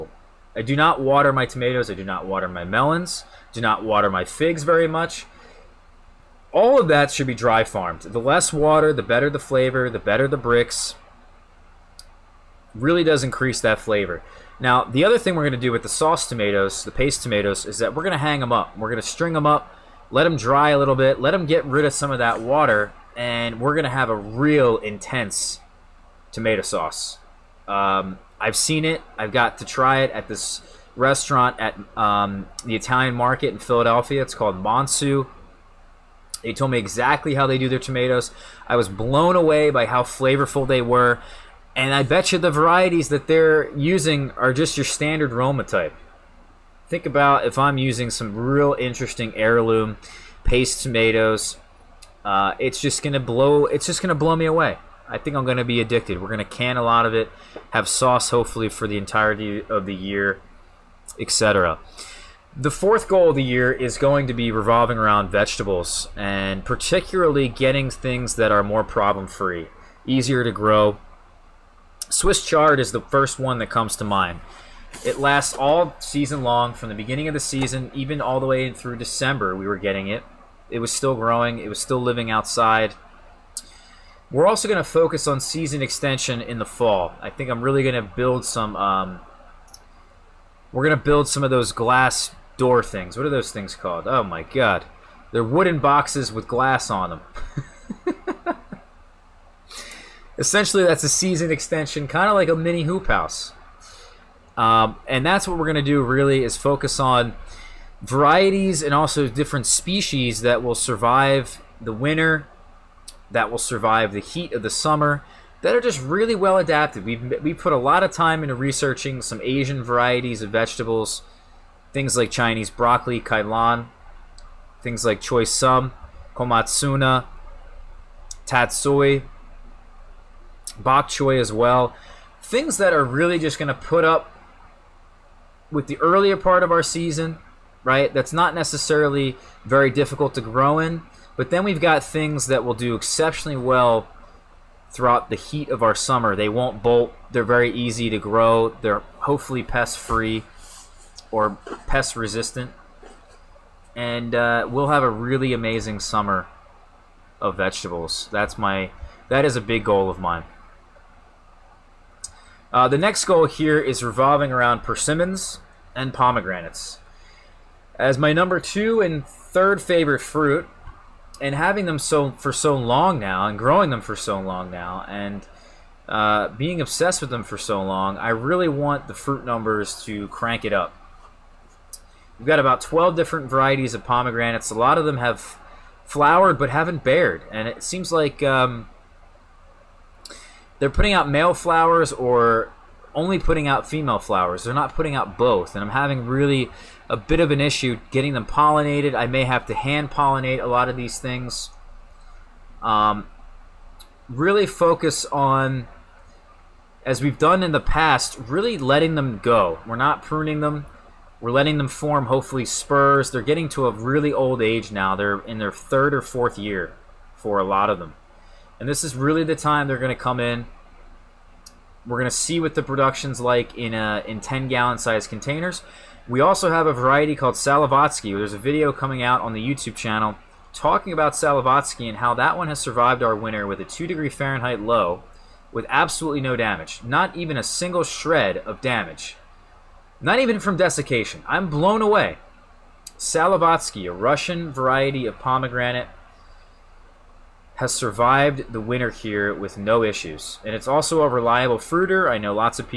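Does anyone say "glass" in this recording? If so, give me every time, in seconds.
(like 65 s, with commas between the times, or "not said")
91 s, 96 s.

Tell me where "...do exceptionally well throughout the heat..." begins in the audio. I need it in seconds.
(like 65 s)
142 s.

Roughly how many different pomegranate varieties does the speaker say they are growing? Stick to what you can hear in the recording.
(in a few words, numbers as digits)
12.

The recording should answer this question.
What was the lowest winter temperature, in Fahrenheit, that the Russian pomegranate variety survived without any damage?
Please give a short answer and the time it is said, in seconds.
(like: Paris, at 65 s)
2 degrees Fahrenheit, at 233 s.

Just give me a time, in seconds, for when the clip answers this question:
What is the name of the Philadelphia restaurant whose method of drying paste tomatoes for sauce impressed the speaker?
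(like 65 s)
34 s.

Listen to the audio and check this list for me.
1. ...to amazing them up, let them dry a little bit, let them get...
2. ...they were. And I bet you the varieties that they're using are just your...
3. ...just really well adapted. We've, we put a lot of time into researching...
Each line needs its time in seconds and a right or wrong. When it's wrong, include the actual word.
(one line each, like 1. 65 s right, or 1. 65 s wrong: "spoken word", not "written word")
1. 19 s wrong: "string", not "amazing"
2. 40 s right
3. 115 s right.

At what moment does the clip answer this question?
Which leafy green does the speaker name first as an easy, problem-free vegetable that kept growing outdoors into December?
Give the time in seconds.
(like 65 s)
72 s.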